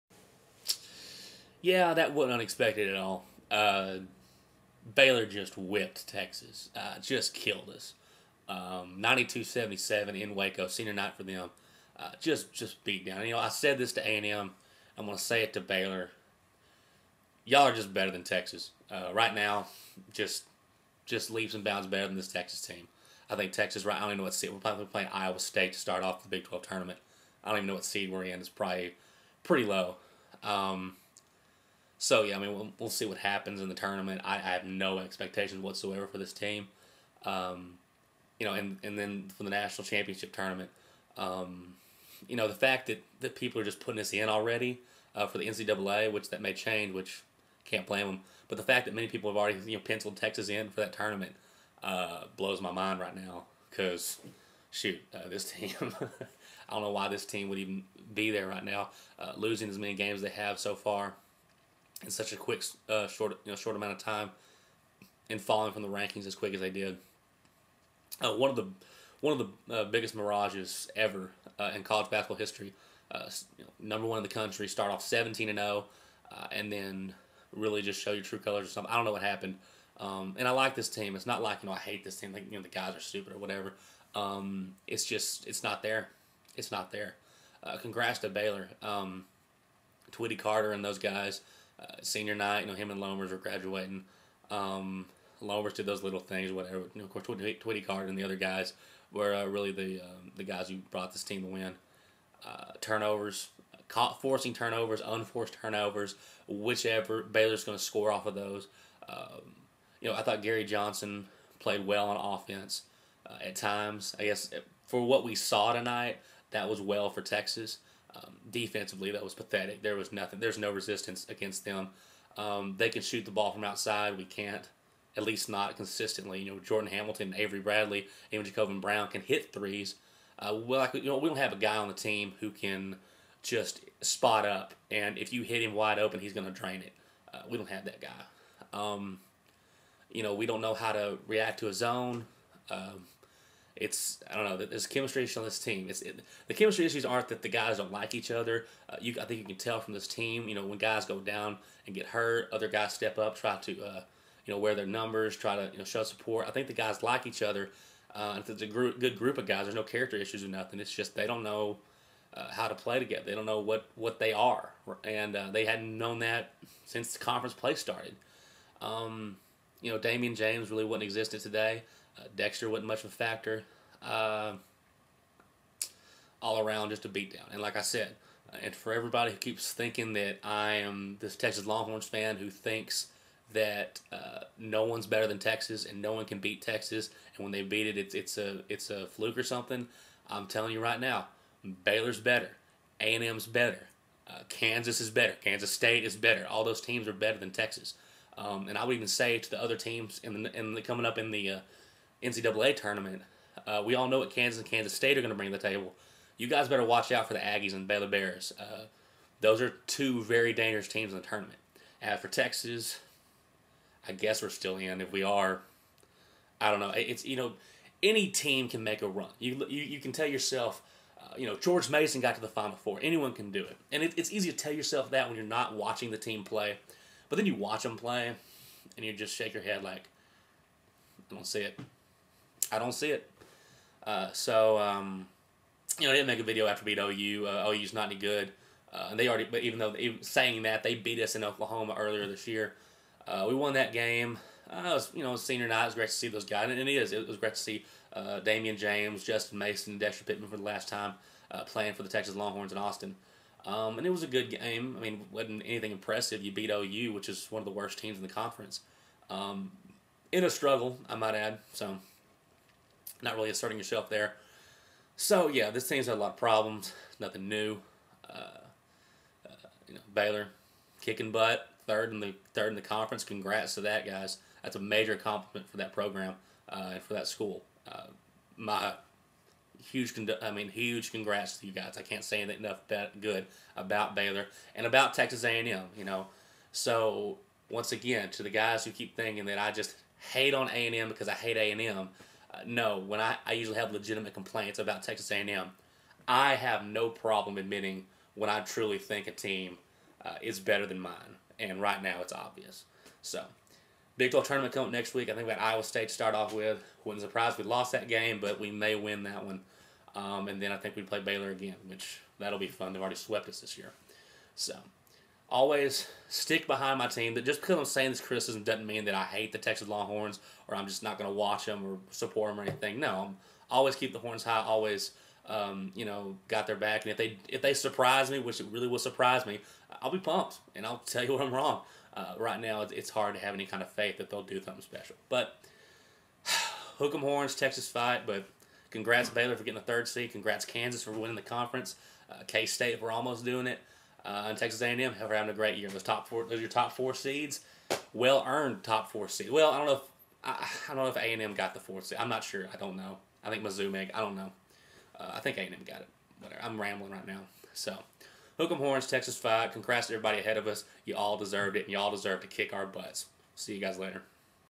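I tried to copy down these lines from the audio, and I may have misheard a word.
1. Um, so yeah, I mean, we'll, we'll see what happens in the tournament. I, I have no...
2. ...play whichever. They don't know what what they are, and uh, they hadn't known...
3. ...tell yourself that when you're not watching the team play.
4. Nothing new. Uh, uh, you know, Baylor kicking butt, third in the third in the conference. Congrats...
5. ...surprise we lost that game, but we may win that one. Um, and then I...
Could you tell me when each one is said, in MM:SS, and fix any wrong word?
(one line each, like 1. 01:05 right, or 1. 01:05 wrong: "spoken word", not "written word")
1. 00:30 right
2. 02:42 wrong: "together", not "whichever"
3. 03:44 right
4. 04:27 right
5. 05:07 right.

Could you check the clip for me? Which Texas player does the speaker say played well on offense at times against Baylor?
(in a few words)
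Gary Johnson.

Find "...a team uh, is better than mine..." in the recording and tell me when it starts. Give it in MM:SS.
04:59.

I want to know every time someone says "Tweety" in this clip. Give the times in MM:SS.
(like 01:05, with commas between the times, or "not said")
01:37.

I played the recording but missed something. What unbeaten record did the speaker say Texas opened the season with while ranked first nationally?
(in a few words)
17-0.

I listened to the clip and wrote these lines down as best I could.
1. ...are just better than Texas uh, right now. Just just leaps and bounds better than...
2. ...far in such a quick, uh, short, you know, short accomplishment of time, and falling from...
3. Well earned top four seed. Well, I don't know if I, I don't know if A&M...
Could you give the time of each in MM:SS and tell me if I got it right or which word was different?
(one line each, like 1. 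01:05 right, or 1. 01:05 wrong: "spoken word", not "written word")
1. 00:17 right
2. 01:00 wrong: "amount", not "accomplishment"
3. 05:48 right.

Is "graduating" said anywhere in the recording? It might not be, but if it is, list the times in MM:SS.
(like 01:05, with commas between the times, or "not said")
01:33.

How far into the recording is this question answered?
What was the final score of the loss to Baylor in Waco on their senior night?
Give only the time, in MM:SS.
00:08.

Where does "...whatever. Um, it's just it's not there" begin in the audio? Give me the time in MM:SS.
01:23.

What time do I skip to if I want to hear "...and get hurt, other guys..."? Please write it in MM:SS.
02:31.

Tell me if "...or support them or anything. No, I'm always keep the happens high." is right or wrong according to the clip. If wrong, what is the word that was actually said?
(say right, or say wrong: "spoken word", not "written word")
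wrong: "horns", not "happens".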